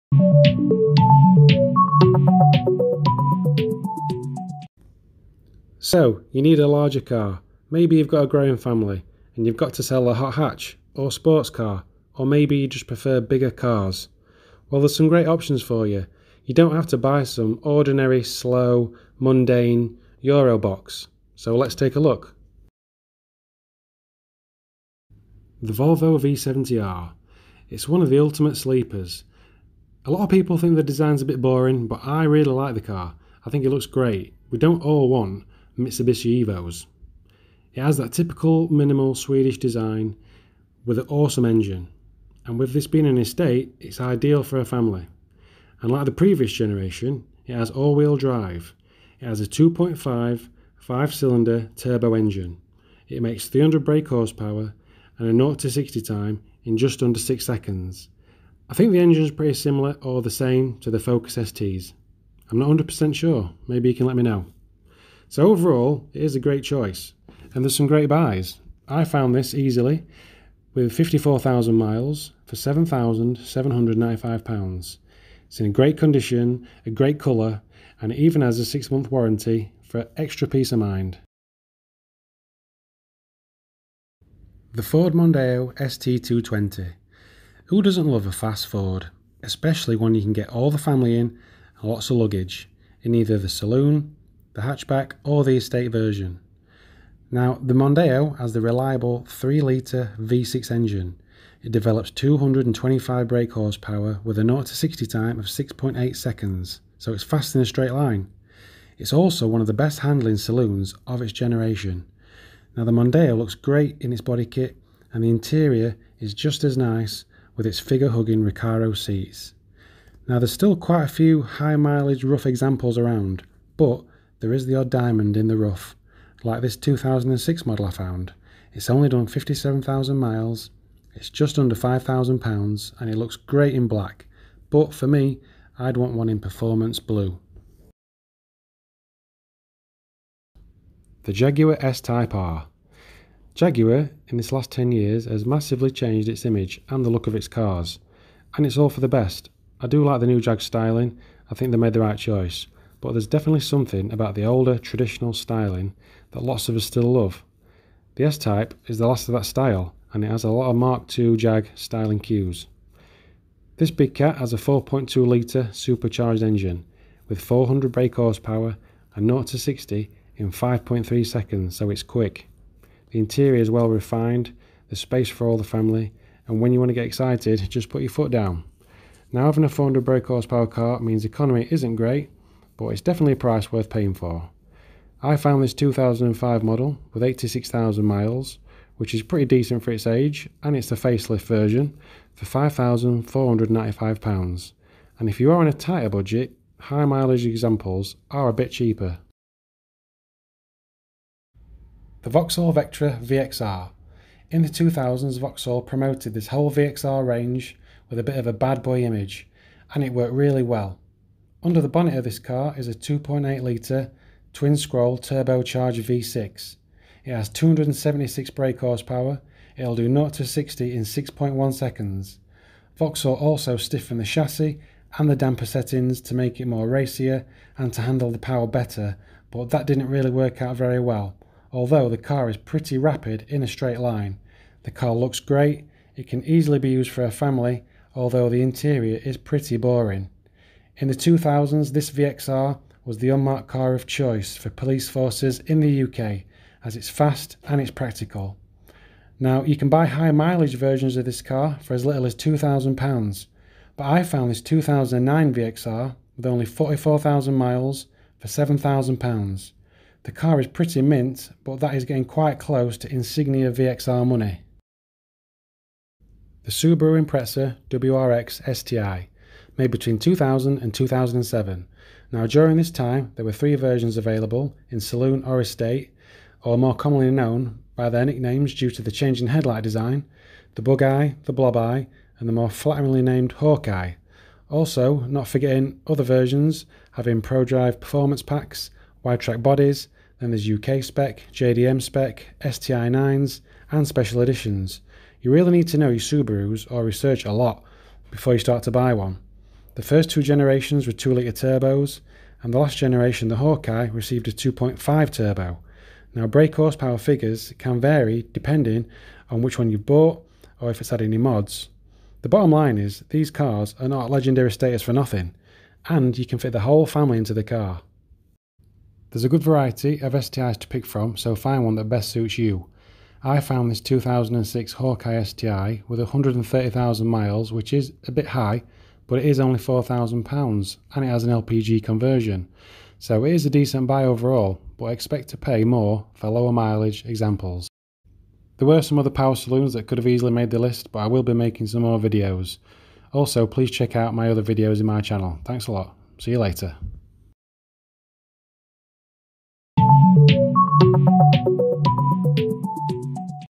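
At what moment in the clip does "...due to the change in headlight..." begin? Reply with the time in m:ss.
4:38.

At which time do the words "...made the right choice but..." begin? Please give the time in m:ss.
2:31.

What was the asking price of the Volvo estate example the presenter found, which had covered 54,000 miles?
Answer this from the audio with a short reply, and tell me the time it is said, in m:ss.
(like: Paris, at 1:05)
£7,795, at 1:12.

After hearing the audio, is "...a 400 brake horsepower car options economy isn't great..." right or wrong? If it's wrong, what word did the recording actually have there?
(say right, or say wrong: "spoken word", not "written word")
wrong: "means", not "options".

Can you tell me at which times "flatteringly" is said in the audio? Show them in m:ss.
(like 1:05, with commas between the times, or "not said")
4:42.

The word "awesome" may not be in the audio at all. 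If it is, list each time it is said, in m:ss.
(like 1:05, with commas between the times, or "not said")
0:41.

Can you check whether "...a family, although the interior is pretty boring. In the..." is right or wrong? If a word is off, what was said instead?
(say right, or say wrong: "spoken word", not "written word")
right.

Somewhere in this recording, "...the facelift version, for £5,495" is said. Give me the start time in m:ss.
3:10.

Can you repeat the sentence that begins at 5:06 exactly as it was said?
Now, brake horsepower figures can vary depending on which one you've bought or if it's had any mods.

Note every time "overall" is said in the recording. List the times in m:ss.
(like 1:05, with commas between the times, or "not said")
1:05, 5:34.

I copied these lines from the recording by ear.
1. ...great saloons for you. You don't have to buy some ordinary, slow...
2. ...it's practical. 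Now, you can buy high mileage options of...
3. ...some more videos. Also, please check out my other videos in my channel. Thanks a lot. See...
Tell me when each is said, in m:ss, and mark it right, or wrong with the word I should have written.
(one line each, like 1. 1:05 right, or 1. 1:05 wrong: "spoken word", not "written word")
1. 0:15 wrong: "options", not "saloons"
2. 4:07 wrong: "versions", not "options"
3. 5:41 right.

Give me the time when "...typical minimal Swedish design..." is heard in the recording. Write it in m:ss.
0:38.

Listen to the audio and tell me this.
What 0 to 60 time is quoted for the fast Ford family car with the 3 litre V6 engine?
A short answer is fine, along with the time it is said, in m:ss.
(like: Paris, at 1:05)
6.8 seconds, at 1:45.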